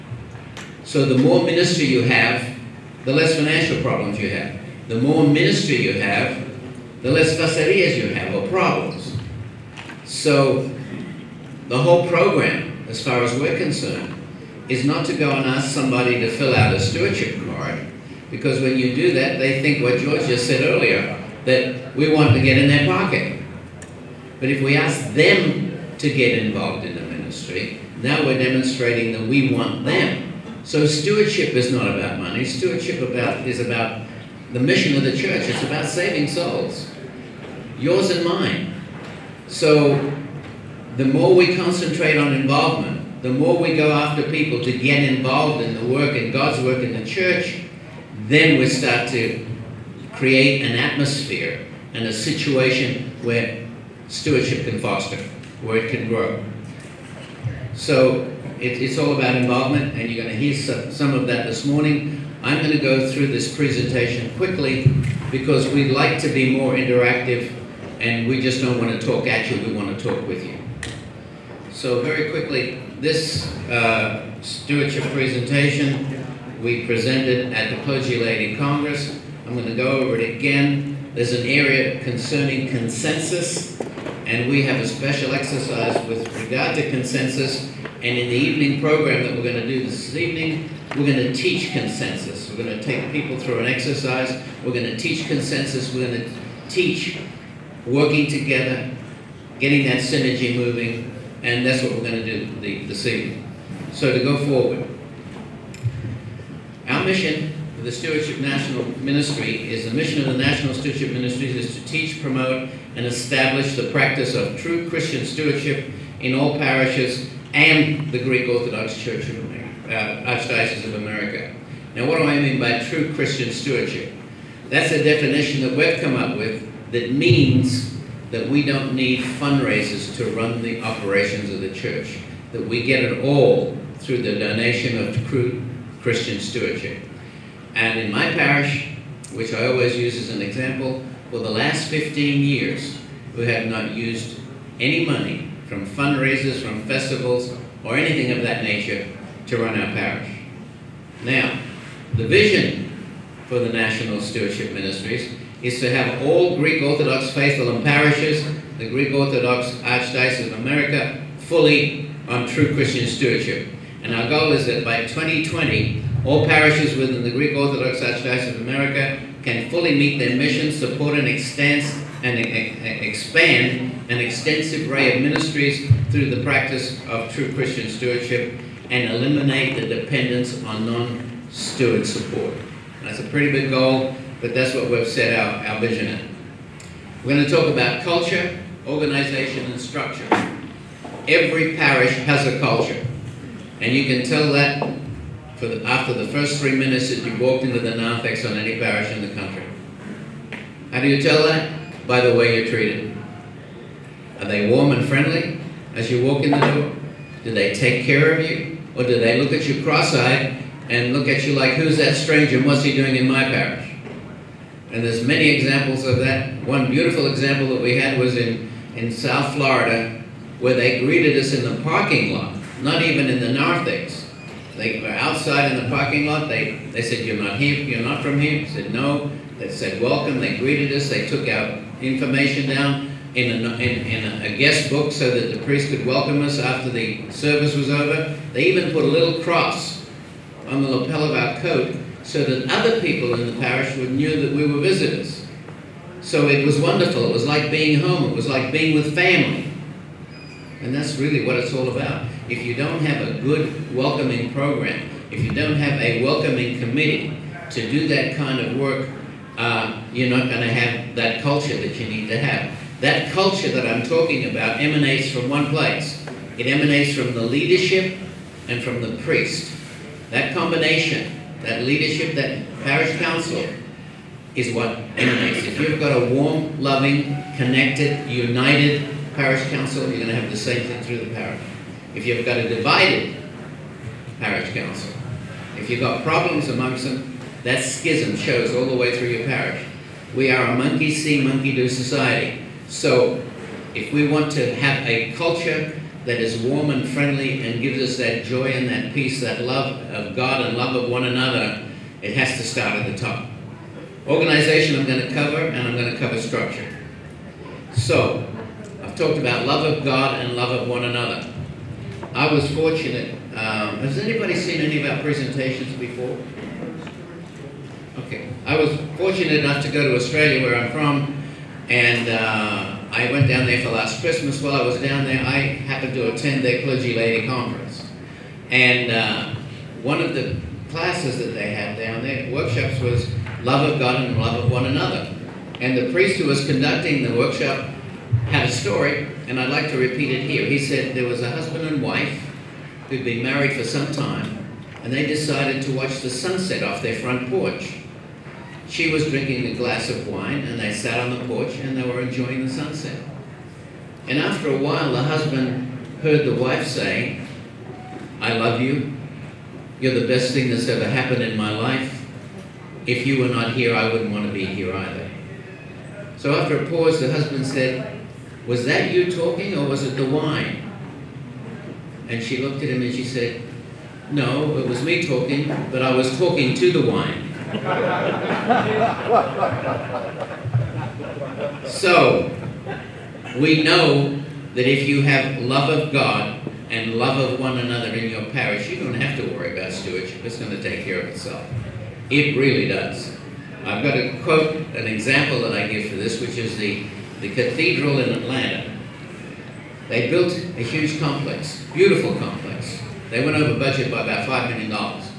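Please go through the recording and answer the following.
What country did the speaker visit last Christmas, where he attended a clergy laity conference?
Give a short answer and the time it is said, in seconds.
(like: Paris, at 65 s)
Australia, at 320 s.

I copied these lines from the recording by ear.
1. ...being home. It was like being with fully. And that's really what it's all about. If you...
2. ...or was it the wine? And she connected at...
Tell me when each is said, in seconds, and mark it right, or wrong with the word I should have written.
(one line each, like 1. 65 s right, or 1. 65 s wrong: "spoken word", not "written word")
1. 247 s wrong: "family", not "fully"
2. 369 s wrong: "looked", not "connected".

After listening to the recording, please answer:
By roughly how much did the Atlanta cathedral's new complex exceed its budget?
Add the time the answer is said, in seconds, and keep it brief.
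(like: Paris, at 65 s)
$5 million, at 404 s.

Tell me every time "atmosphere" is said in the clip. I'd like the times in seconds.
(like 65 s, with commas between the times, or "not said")
50 s.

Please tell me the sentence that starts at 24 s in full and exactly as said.
But if we ask them to get involved in the ministry, now we're demonstrating that we want them.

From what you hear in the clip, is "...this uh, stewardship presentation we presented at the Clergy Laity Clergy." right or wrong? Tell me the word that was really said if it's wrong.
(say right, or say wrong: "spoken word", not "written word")
wrong: "Congress", not "Clergy".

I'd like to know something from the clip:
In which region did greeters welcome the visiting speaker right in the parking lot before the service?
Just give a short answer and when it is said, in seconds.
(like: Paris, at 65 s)
South Florida, at 219 s.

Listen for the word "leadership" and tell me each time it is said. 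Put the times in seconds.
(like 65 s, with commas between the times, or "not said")
267 s, 271 s.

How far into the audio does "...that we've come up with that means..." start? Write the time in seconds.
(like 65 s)
125 s.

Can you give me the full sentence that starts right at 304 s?
Organization I'm going to cover, and I'm going to cover structure.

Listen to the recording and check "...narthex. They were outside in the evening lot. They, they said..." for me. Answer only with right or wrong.
wrong.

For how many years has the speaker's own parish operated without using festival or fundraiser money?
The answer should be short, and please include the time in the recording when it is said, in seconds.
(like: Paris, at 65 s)
15 years, at 141 s.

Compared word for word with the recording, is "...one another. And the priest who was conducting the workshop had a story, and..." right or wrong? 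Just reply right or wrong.
right.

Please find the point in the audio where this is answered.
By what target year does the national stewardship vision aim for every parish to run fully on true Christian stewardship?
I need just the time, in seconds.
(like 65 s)
165 s.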